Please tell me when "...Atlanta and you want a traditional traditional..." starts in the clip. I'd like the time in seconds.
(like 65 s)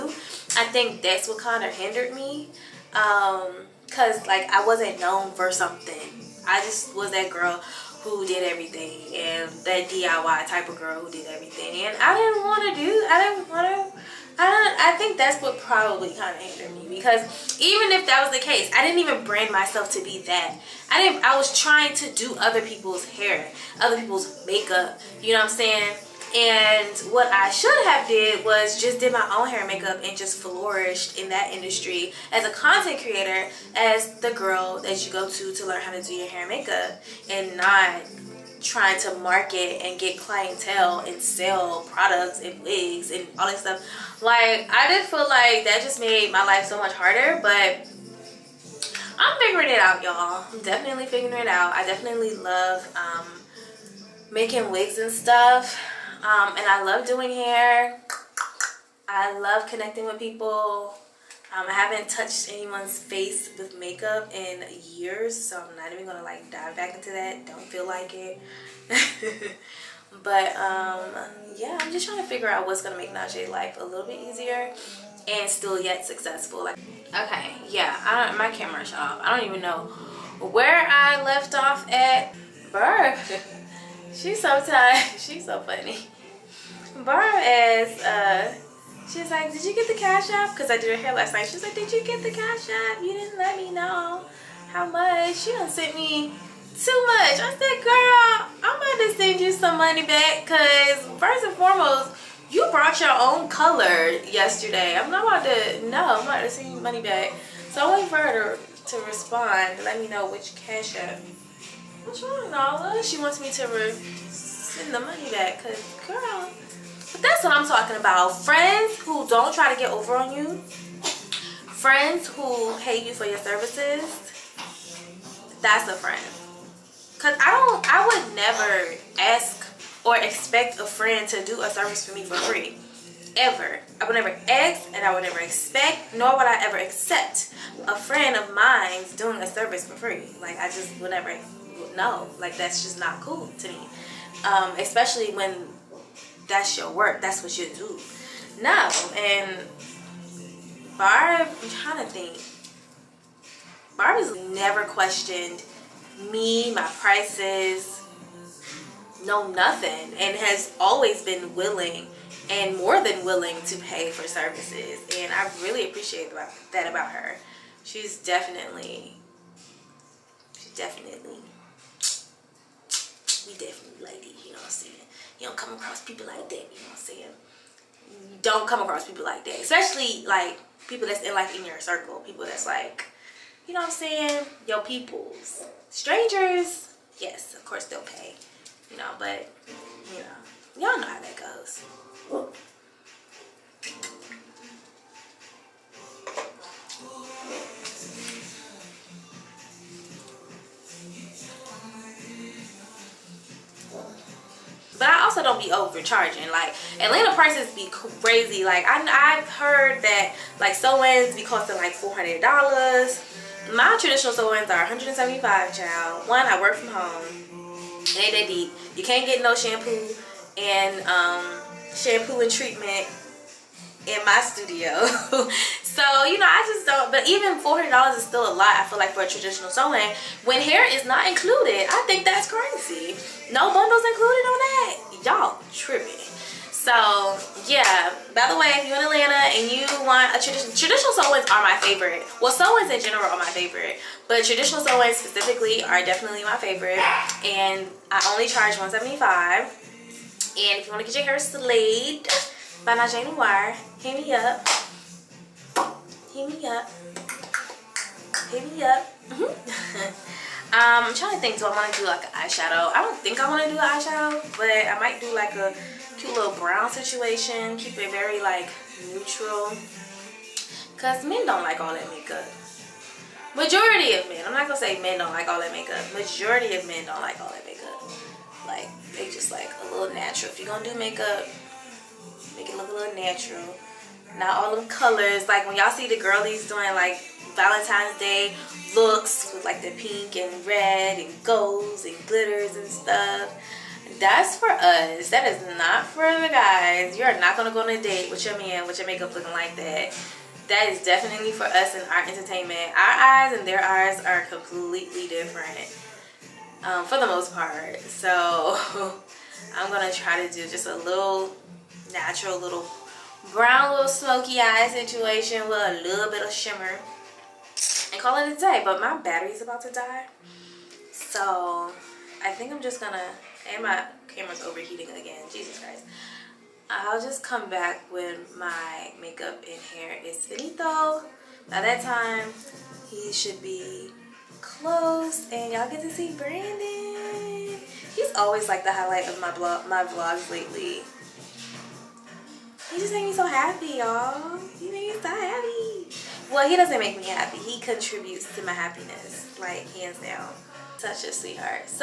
239 s.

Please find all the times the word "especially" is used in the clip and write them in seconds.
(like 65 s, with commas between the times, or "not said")
144 s, 179 s.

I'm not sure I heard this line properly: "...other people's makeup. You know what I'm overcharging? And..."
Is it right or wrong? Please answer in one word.
wrong.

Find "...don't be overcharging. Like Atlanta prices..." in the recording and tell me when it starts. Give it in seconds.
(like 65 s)
205 s.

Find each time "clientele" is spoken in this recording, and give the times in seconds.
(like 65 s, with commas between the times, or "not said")
40 s.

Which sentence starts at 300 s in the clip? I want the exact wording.
That is definitely for us and our entertainment.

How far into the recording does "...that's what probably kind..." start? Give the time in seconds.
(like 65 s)
15 s.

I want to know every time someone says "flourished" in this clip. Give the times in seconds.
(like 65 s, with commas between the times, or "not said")
30 s.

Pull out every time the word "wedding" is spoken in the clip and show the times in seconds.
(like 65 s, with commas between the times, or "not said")
not said.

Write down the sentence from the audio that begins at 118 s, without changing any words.
Friends who don't try to get over on you.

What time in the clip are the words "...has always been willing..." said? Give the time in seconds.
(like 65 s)
160 s.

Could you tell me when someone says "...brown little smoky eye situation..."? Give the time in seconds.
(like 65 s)
313 s.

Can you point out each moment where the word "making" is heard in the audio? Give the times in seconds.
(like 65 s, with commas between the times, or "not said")
54 s.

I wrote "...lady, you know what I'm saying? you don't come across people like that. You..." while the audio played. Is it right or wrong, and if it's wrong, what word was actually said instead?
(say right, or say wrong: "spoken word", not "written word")
right.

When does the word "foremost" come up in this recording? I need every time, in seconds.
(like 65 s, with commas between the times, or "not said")
101 s.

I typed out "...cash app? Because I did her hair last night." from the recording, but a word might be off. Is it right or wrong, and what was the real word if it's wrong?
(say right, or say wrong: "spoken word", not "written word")
right.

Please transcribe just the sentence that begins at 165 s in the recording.
And I really appreciate that about her.